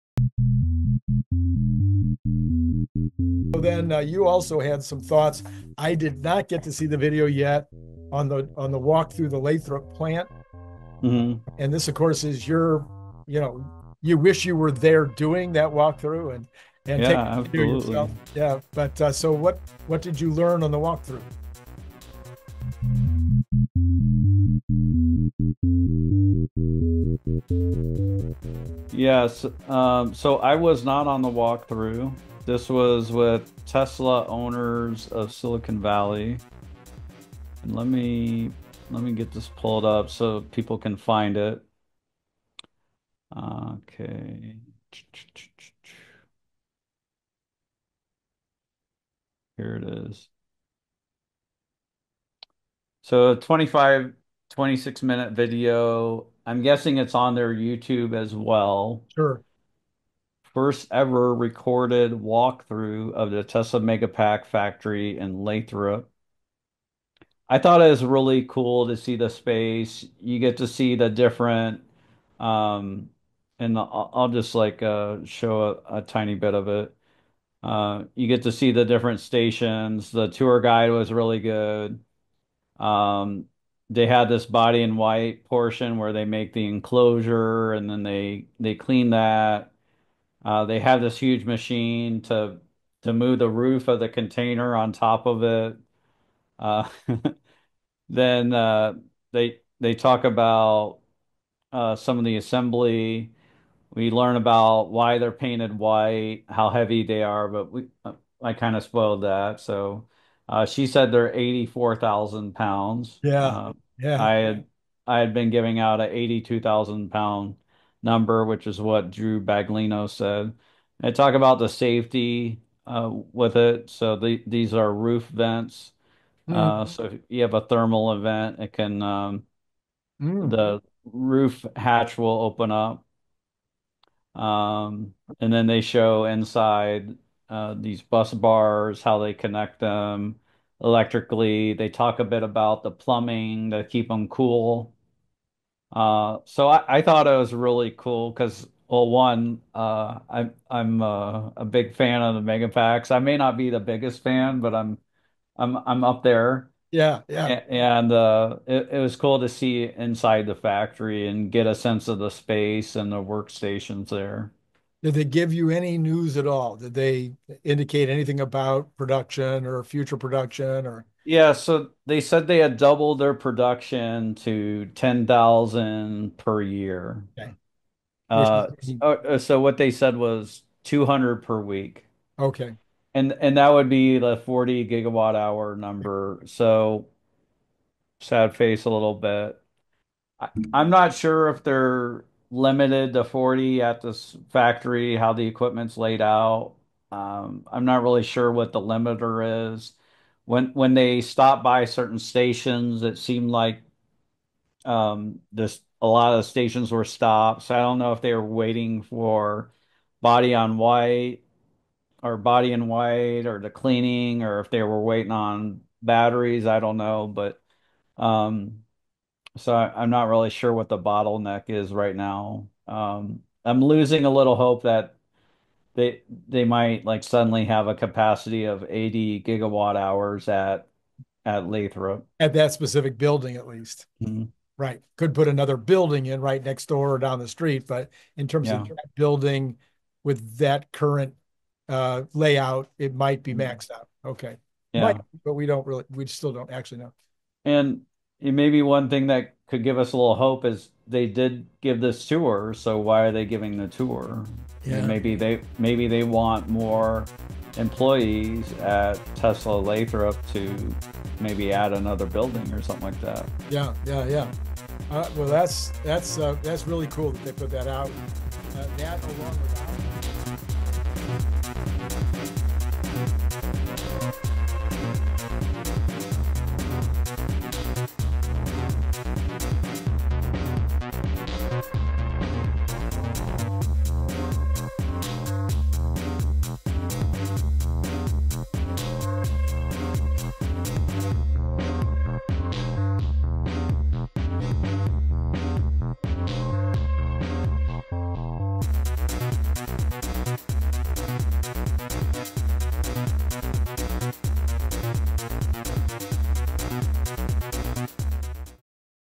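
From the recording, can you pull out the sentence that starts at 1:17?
Uh, you get to see the different stations.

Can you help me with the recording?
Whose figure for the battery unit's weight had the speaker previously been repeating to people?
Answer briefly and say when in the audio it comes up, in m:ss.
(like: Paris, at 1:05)
Drew Baglino, at 1:59.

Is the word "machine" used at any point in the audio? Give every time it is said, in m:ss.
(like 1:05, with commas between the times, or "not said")
1:31.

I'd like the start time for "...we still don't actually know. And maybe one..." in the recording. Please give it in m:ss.
4:06.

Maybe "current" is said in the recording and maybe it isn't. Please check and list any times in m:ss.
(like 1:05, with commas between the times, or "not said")
4:00.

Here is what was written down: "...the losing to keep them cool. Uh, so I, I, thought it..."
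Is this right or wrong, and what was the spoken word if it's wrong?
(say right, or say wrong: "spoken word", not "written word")
wrong: "plumbing", not "losing".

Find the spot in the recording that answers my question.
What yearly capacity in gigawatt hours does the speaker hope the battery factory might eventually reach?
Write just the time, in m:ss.
3:48.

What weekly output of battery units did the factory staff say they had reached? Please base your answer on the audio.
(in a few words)
200 per week.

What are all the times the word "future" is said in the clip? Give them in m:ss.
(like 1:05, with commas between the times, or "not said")
2:49.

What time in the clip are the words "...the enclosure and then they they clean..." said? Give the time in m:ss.
1:26.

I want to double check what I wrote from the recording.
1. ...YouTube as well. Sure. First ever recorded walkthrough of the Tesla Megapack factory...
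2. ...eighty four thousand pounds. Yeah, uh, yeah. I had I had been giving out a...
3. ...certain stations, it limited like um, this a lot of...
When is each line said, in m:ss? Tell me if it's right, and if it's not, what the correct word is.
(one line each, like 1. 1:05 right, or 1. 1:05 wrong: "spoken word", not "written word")
1. 0:57 right
2. 1:51 right
3. 3:21 wrong: "seemed", not "limited".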